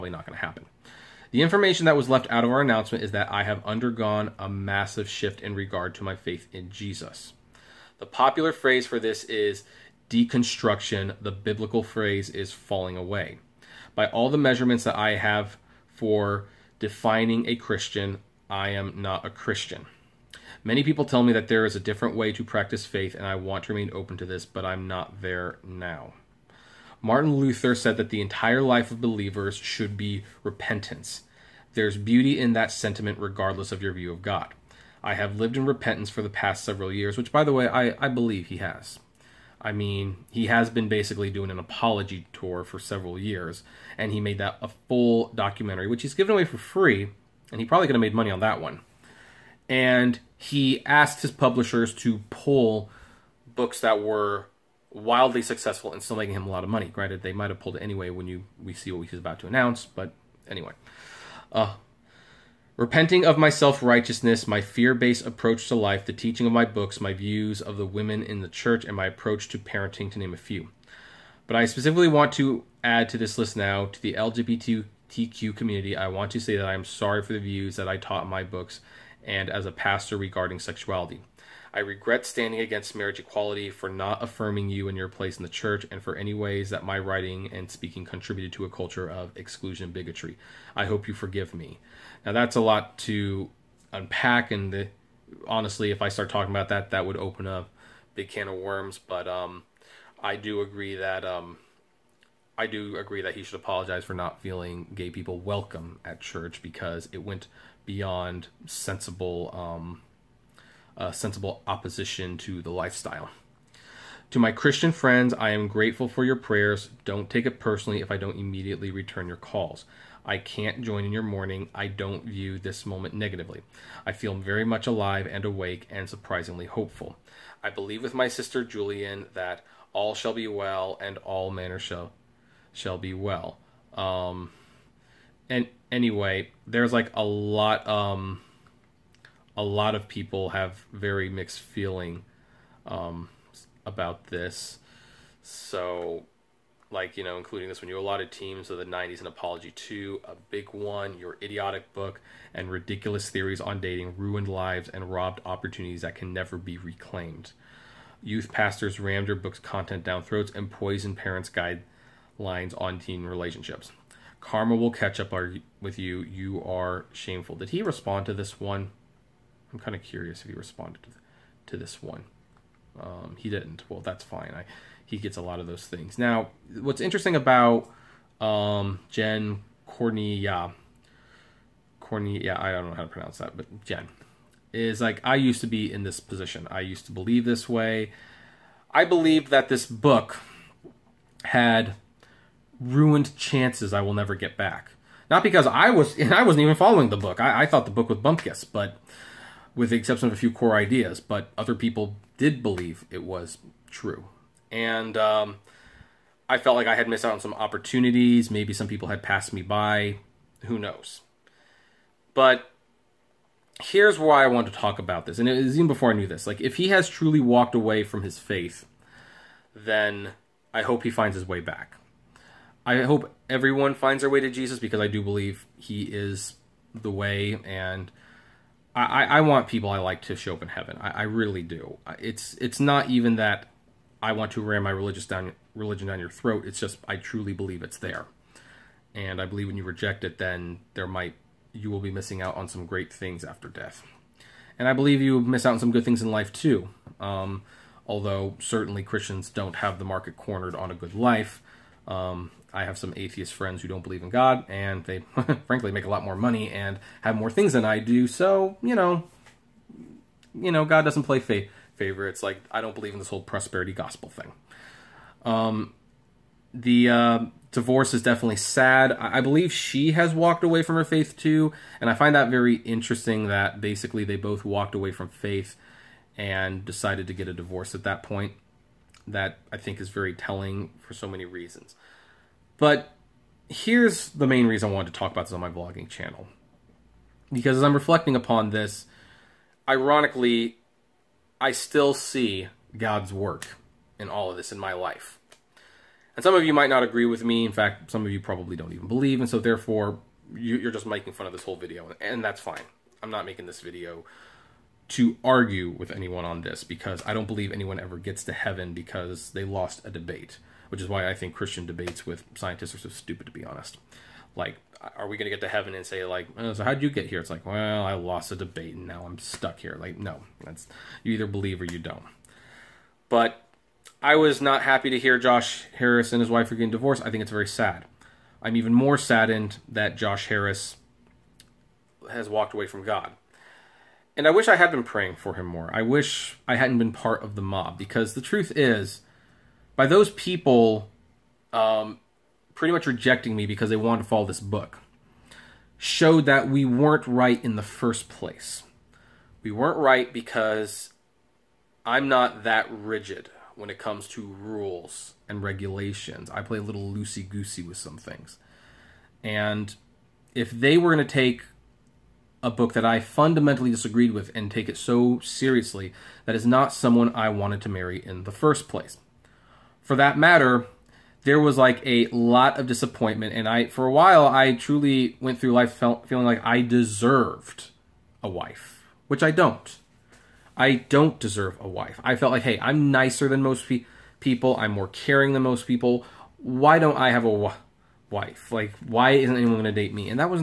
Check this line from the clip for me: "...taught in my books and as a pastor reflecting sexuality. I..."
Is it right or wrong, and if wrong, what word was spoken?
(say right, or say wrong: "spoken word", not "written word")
wrong: "regarding", not "reflecting".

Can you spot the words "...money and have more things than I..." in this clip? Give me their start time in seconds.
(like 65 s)
256 s.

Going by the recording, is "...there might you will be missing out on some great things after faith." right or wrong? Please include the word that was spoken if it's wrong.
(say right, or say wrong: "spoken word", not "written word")
wrong: "death", not "faith".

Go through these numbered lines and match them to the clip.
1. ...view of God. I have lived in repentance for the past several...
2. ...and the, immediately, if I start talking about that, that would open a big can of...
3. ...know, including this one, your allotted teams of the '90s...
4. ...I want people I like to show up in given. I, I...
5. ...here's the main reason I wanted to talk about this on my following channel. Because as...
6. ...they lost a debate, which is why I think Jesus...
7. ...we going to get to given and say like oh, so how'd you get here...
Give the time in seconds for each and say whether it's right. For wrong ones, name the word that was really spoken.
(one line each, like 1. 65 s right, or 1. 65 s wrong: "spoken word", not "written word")
1. 33 s right
2. 94 s wrong: "honestly", not "immediately"
3. 147 s right
4. 229 s wrong: "heaven", not "given"
5. 283 s wrong: "vlogging", not "following"
6. 309 s wrong: "Christian", not "Jesus"
7. 315 s wrong: "heaven", not "given".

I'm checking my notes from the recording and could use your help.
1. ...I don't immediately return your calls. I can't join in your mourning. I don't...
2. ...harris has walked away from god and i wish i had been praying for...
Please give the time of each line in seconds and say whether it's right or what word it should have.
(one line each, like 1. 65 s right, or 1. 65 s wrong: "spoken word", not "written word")
1. 118 s right
2. 330 s right.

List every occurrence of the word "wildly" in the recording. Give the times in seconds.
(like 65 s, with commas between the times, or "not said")
54 s.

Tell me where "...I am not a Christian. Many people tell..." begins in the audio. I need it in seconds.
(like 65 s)
18 s.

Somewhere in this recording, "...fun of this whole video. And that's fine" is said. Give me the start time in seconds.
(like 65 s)
301 s.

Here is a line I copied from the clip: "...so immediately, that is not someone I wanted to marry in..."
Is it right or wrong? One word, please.
wrong.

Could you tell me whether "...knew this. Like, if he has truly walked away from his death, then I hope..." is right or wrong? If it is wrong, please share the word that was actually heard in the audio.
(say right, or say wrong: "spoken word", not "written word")
wrong: "faith", not "death".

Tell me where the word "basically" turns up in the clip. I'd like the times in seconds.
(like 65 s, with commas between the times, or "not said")
40 s, 273 s.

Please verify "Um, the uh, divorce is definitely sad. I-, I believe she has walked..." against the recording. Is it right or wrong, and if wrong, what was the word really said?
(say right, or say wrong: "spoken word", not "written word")
right.